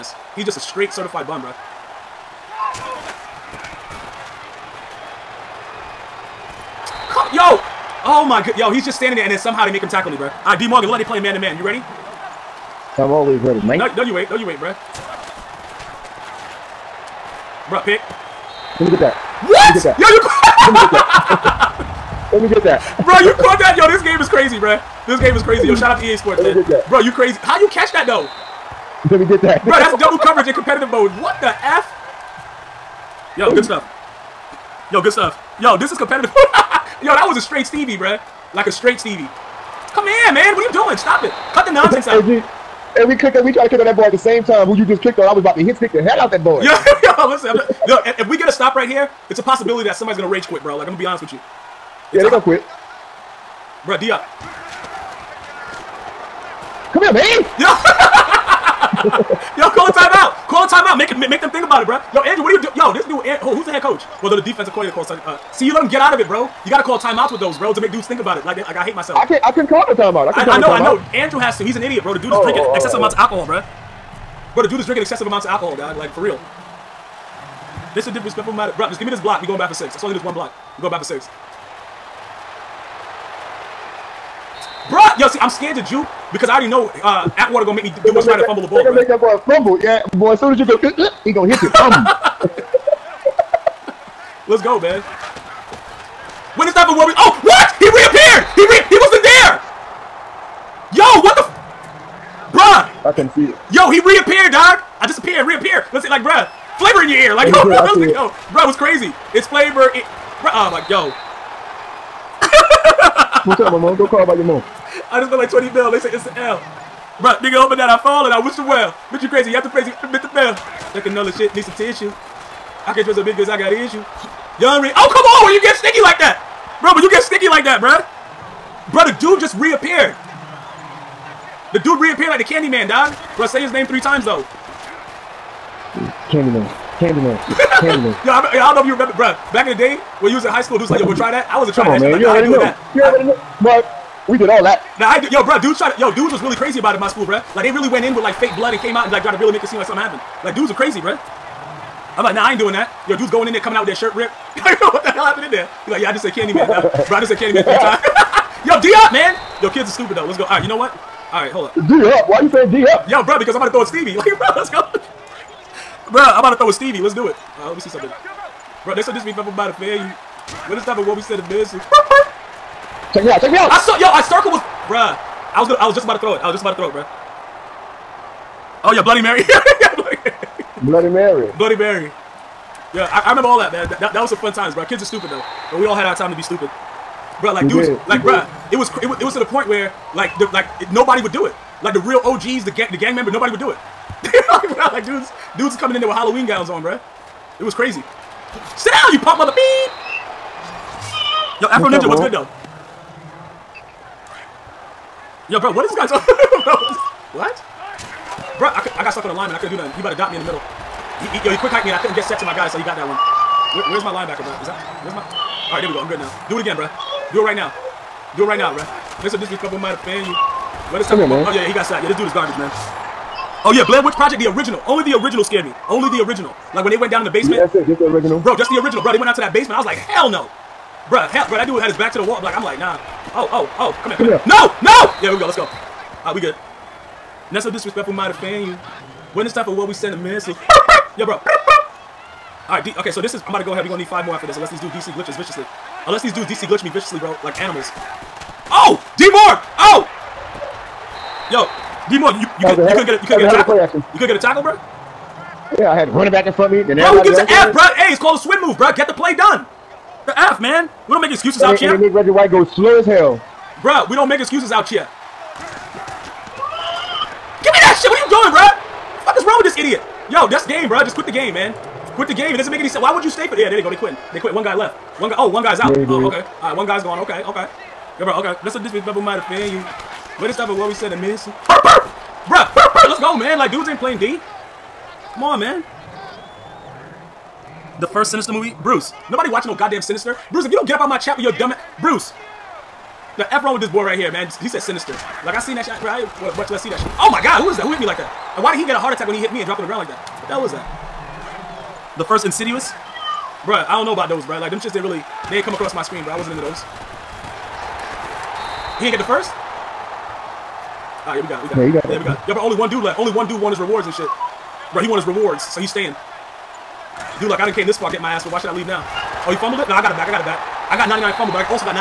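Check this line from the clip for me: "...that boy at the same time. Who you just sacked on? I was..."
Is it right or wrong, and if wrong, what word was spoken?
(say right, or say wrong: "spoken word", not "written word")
wrong: "kicked", not "sacked".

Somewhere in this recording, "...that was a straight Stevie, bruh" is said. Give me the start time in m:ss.
0:37.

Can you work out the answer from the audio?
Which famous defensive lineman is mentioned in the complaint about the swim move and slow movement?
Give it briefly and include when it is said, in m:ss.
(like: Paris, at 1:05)
Reggie White, at 4:22.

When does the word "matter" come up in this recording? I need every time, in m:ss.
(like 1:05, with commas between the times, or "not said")
1:18.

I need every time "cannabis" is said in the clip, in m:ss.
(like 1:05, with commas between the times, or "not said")
not said.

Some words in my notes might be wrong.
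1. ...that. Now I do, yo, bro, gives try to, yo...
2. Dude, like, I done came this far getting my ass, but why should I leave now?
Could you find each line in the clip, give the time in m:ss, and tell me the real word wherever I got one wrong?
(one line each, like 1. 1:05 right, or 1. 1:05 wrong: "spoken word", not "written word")
1. 2:24 wrong: "dudes", not "gives"
2. 5:17 right.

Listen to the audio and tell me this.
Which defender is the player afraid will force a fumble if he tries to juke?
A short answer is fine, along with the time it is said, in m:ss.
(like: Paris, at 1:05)
Atwater, at 1:27.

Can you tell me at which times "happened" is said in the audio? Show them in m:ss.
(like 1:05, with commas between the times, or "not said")
2:30, 2:35.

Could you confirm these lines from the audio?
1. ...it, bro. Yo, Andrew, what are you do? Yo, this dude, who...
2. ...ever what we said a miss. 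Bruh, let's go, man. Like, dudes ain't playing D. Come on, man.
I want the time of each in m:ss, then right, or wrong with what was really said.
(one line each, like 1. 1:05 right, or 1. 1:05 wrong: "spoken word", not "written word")
1. 1:01 right
2. 4:40 right.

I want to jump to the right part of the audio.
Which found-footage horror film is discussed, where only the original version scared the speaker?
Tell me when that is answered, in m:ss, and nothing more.
3:43.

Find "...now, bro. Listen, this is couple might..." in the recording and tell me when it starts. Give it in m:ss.
3:38.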